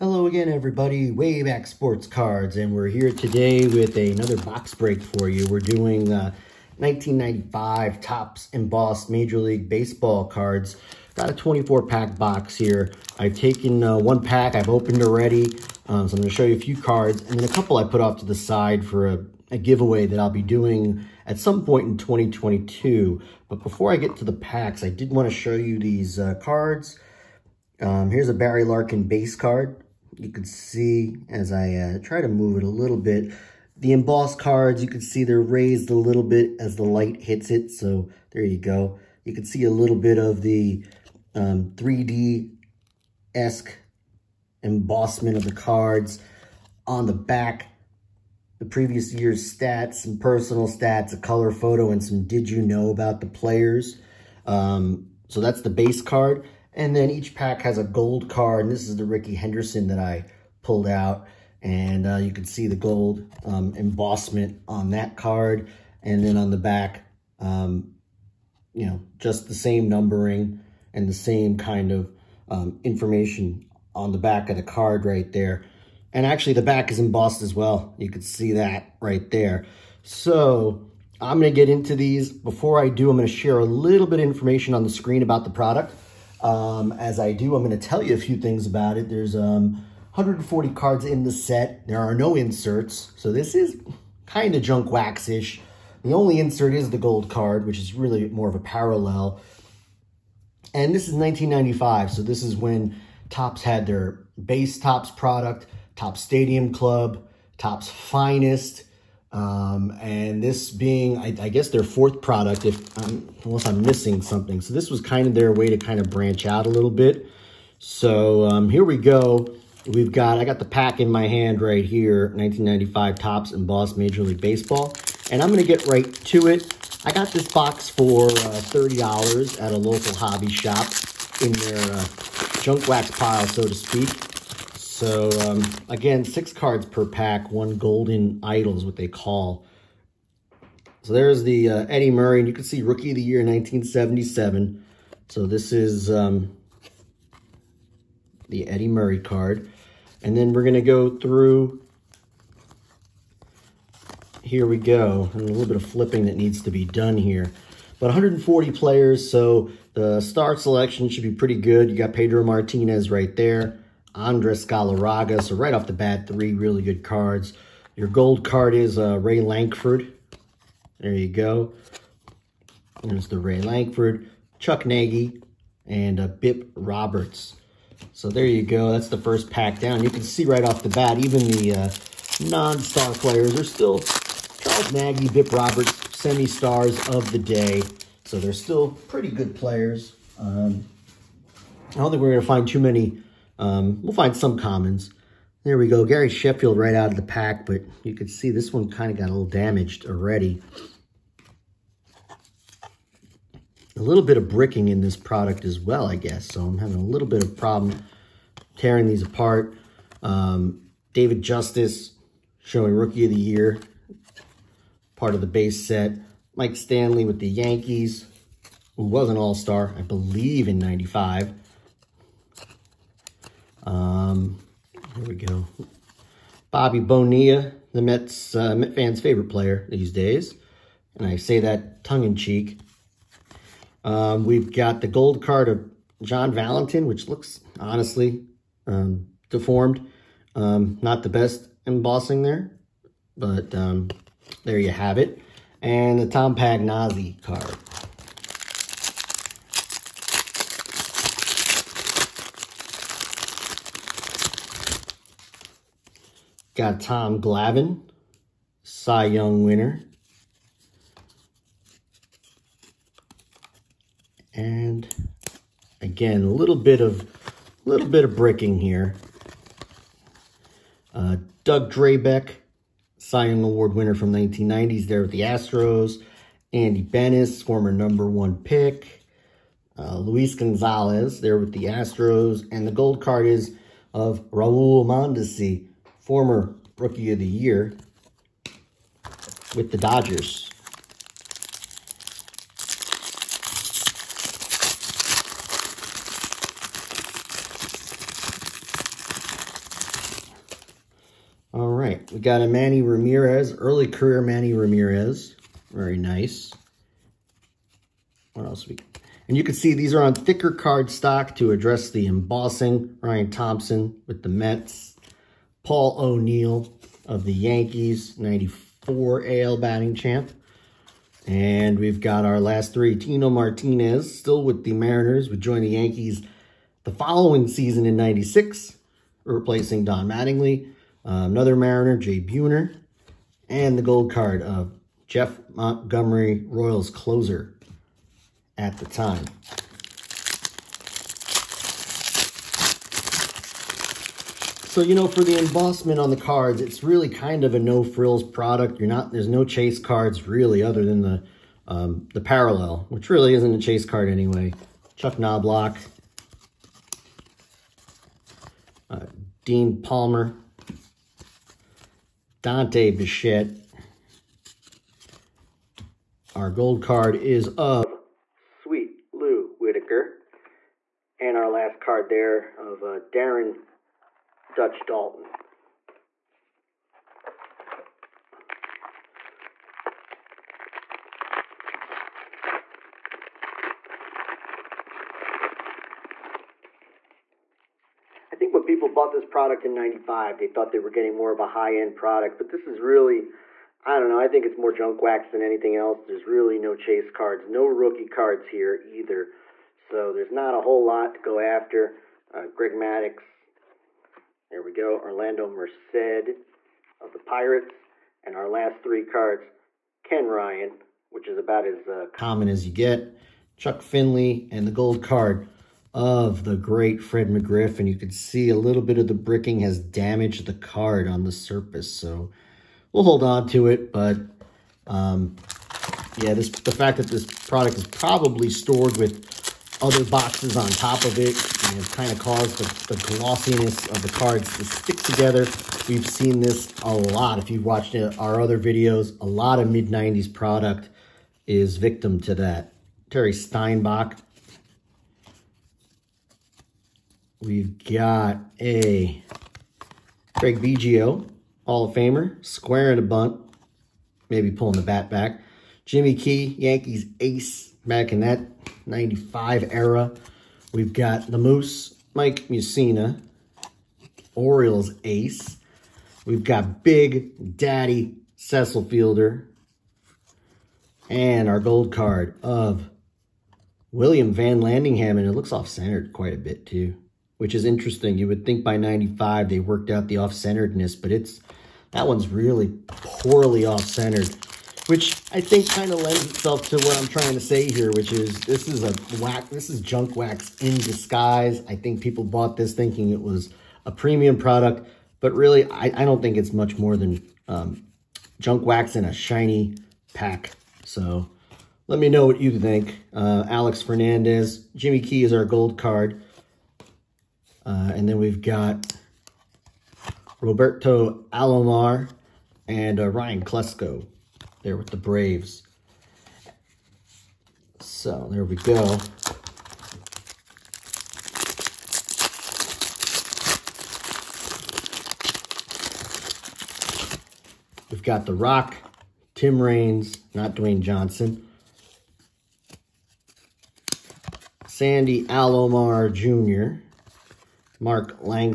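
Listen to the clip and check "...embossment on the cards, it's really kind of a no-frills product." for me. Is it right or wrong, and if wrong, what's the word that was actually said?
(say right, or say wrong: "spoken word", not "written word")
right.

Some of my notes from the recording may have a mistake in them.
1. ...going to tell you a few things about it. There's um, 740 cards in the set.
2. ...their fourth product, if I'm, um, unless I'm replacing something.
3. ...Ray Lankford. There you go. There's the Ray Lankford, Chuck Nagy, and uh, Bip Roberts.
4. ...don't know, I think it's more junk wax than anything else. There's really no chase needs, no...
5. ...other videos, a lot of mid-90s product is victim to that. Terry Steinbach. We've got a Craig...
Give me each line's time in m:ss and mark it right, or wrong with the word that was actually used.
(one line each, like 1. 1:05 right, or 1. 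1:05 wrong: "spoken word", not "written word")
1. 1:27 wrong: "140", not "740"
2. 1:51 wrong: "missing", not "replacing"
3. 2:49 right
4. 6:34 wrong: "cards", not "needs"
5. 7:18 right.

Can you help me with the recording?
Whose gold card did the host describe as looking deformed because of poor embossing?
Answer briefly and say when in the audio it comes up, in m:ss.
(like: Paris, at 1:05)
John Valentin, at 3:56.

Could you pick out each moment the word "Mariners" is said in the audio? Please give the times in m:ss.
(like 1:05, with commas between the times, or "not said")
5:24, 5:31.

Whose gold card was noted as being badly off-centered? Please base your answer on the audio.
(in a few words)
William VanLandingham.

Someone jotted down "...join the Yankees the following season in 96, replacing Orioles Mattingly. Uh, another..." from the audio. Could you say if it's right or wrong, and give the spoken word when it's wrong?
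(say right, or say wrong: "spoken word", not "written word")
wrong: "Don", not "Orioles".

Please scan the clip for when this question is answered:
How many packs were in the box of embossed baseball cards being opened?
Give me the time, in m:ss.
0:11.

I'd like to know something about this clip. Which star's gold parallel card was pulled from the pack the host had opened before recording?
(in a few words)
Rickey Henderson.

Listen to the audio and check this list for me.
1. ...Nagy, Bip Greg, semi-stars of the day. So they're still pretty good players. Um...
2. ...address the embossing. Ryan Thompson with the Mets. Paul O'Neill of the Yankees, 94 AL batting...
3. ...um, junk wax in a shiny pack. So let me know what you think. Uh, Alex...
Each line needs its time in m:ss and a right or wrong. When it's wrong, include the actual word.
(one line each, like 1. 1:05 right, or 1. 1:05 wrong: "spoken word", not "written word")
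1. 3:04 wrong: "Roberts", not "Greg"
2. 5:11 right
3. 8:17 right.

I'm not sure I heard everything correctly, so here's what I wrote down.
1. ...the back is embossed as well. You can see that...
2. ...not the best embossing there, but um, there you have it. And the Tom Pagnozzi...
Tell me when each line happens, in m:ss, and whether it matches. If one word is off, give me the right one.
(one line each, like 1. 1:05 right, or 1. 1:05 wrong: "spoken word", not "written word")
1. 1:16 right
2. 4:01 right.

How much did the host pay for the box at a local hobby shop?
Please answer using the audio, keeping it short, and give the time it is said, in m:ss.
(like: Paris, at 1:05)
$30, at 2:08.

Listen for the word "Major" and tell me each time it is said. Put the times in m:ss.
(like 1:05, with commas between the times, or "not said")
0:09, 2:03.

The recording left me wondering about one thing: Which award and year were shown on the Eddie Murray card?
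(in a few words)
Rookie of the Year 1977.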